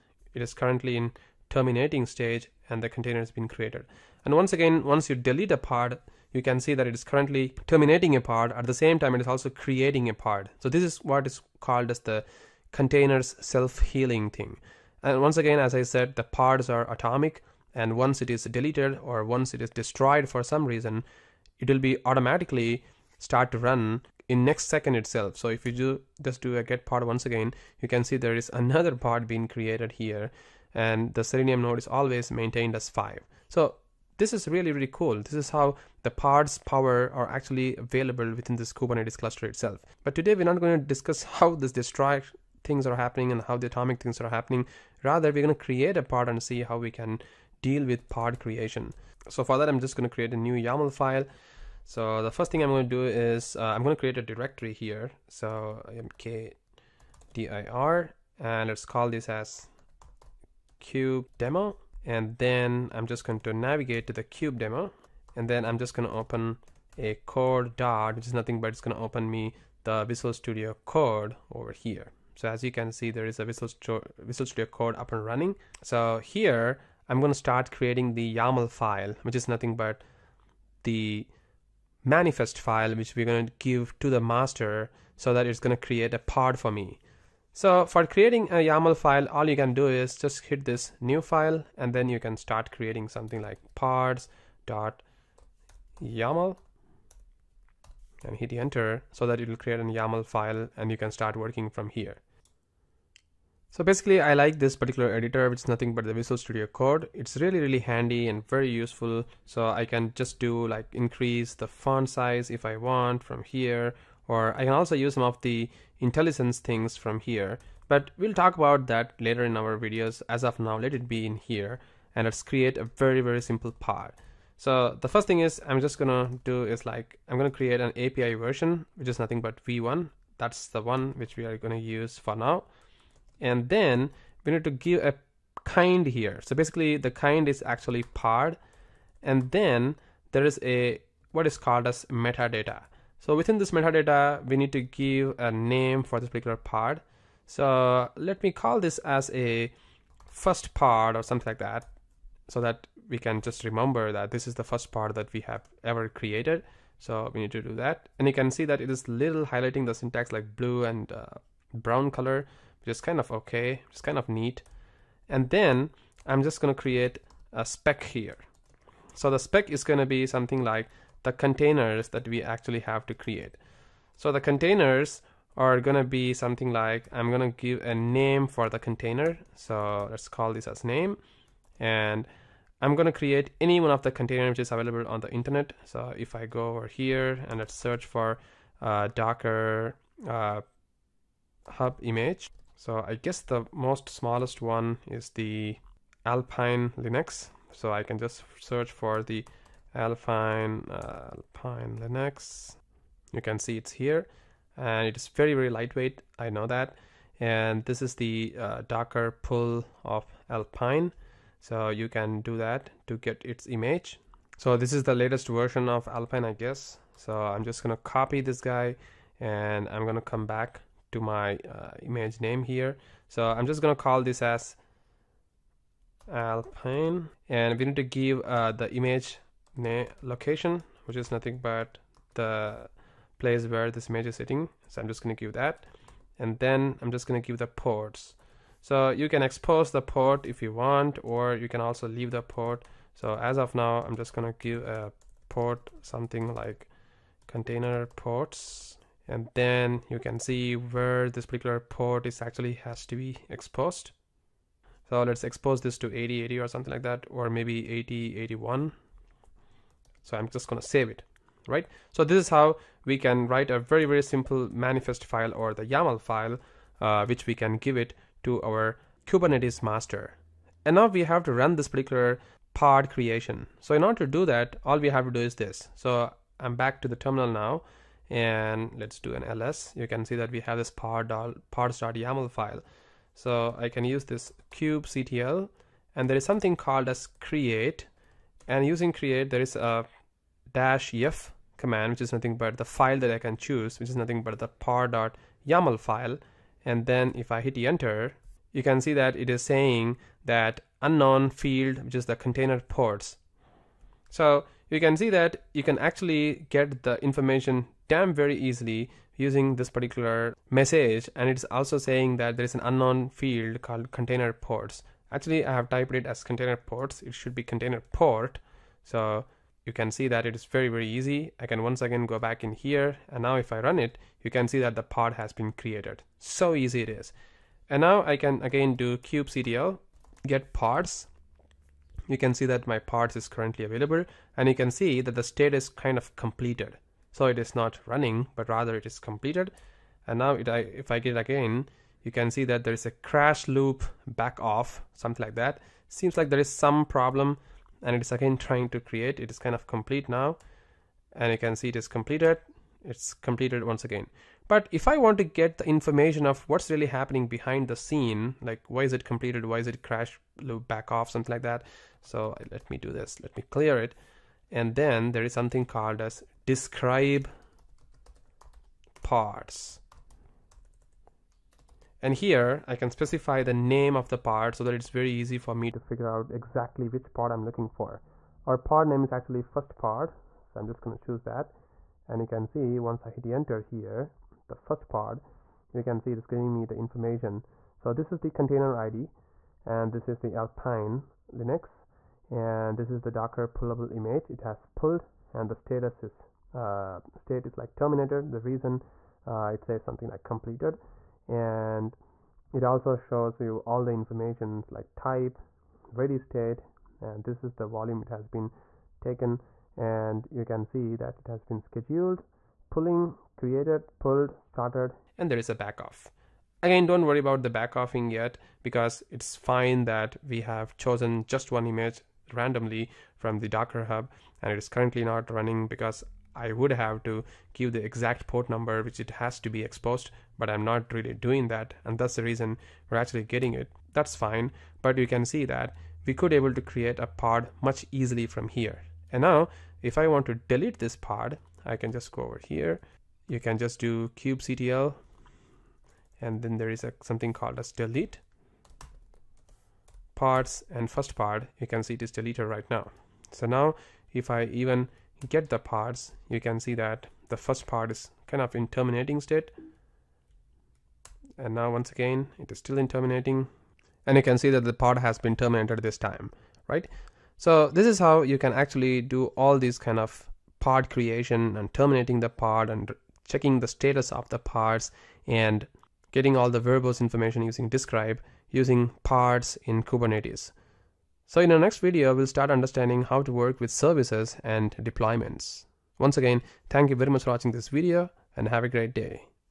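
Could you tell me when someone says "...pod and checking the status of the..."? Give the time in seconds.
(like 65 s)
472 s.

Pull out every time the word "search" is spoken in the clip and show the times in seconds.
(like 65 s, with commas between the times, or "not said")
187 s, 198 s.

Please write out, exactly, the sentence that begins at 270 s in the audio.
And now we have to run this particular pod creation.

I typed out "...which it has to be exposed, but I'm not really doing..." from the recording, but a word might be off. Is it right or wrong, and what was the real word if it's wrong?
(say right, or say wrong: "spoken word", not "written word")
right.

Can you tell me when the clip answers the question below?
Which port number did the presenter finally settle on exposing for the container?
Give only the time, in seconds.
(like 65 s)
257 s.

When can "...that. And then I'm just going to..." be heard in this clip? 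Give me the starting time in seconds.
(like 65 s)
235 s.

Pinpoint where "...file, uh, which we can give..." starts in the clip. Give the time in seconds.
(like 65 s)
266 s.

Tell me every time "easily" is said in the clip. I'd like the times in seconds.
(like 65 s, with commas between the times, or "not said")
308 s, 438 s.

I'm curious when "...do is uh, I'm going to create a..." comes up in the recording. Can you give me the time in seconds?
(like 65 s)
52 s.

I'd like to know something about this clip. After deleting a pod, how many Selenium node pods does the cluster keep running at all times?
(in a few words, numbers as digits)
5.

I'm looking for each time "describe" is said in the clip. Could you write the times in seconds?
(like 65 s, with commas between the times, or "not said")
366 s, 477 s.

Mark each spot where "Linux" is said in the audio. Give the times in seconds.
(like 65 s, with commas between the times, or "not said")
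196 s, 201 s, 391 s.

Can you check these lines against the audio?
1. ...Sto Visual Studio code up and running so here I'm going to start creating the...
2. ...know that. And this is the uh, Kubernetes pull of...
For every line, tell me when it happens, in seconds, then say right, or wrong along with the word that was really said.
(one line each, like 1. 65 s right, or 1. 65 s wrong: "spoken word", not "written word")
1. 73 s right
2. 206 s wrong: "Docker", not "Kubernetes".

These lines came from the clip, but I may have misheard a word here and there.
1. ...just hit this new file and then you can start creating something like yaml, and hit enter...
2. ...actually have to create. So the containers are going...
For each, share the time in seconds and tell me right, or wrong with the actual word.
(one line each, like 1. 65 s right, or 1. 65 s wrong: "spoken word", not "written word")
1. 90 s right
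2. 172 s right.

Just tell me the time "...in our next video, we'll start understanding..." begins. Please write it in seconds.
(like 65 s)
481 s.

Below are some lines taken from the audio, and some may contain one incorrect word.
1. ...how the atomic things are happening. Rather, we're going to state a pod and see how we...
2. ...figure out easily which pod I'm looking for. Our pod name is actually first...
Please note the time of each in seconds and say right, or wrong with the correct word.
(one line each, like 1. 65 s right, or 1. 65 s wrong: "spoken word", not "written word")
1. 43 s wrong: "create", not "state"
2. 375 s wrong: "exactly", not "easily".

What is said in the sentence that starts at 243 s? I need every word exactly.
So as of now, I'm just going to give a port something like container ports.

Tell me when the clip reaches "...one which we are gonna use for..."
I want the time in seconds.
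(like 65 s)
130 s.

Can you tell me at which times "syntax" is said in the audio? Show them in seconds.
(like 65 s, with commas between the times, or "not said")
159 s.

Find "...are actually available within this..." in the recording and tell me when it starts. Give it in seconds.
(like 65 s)
37 s.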